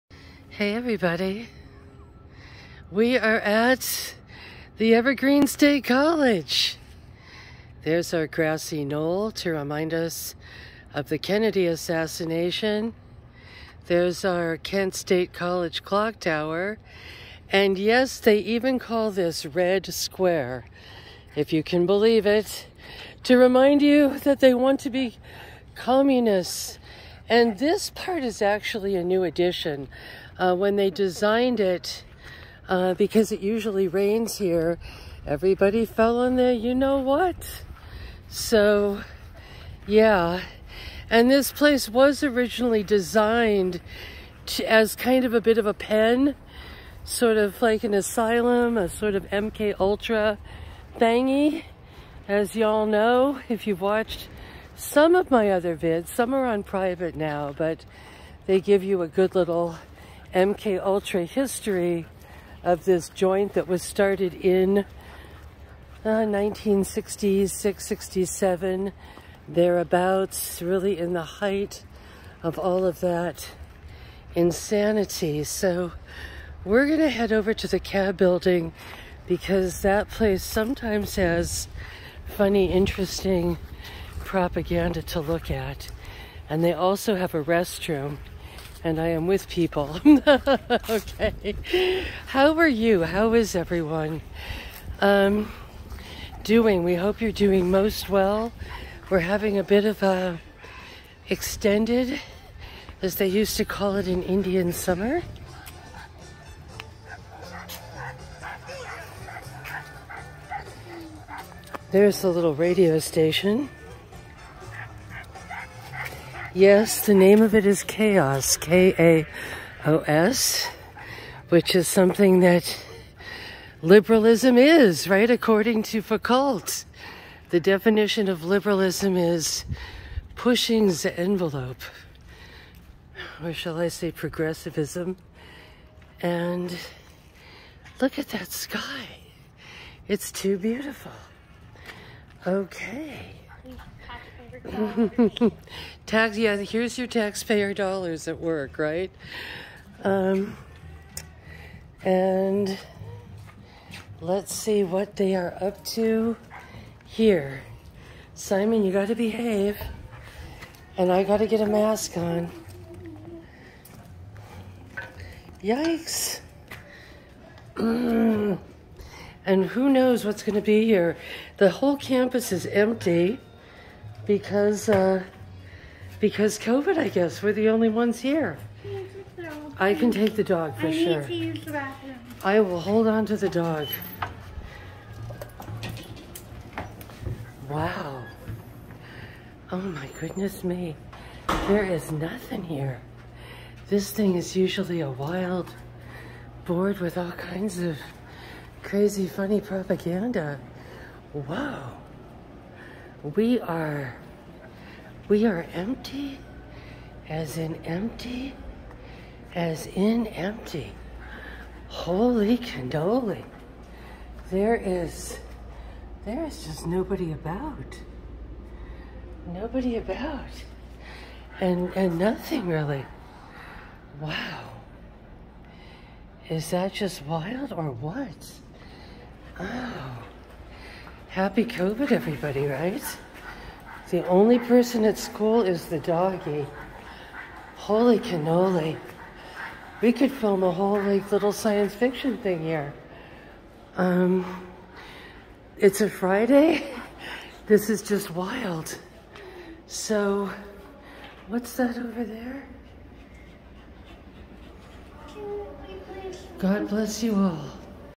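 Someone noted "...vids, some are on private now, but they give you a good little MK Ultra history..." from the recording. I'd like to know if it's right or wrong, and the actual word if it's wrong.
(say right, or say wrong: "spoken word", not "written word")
right.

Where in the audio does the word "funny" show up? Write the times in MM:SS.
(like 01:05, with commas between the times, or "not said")
01:22, 03:19.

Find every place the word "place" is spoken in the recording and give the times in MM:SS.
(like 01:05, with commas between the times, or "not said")
00:41, 01:20.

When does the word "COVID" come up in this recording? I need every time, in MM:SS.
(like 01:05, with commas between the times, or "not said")
02:56, 03:51.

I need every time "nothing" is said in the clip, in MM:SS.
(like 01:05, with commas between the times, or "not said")
03:12, 03:42.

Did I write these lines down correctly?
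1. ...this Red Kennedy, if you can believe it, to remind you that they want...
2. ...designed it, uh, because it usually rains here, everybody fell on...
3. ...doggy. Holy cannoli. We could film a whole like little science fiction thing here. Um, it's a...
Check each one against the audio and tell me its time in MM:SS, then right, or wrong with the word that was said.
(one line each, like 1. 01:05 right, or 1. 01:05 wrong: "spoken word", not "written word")
1. 00:19 wrong: "Square", not "Kennedy"
2. 00:30 right
3. 03:55 right.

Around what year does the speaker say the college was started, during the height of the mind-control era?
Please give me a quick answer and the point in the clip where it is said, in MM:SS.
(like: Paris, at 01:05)
1966, at 01:06.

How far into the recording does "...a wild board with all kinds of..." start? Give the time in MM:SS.
03:15.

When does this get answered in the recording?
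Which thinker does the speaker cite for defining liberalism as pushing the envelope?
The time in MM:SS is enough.
02:06.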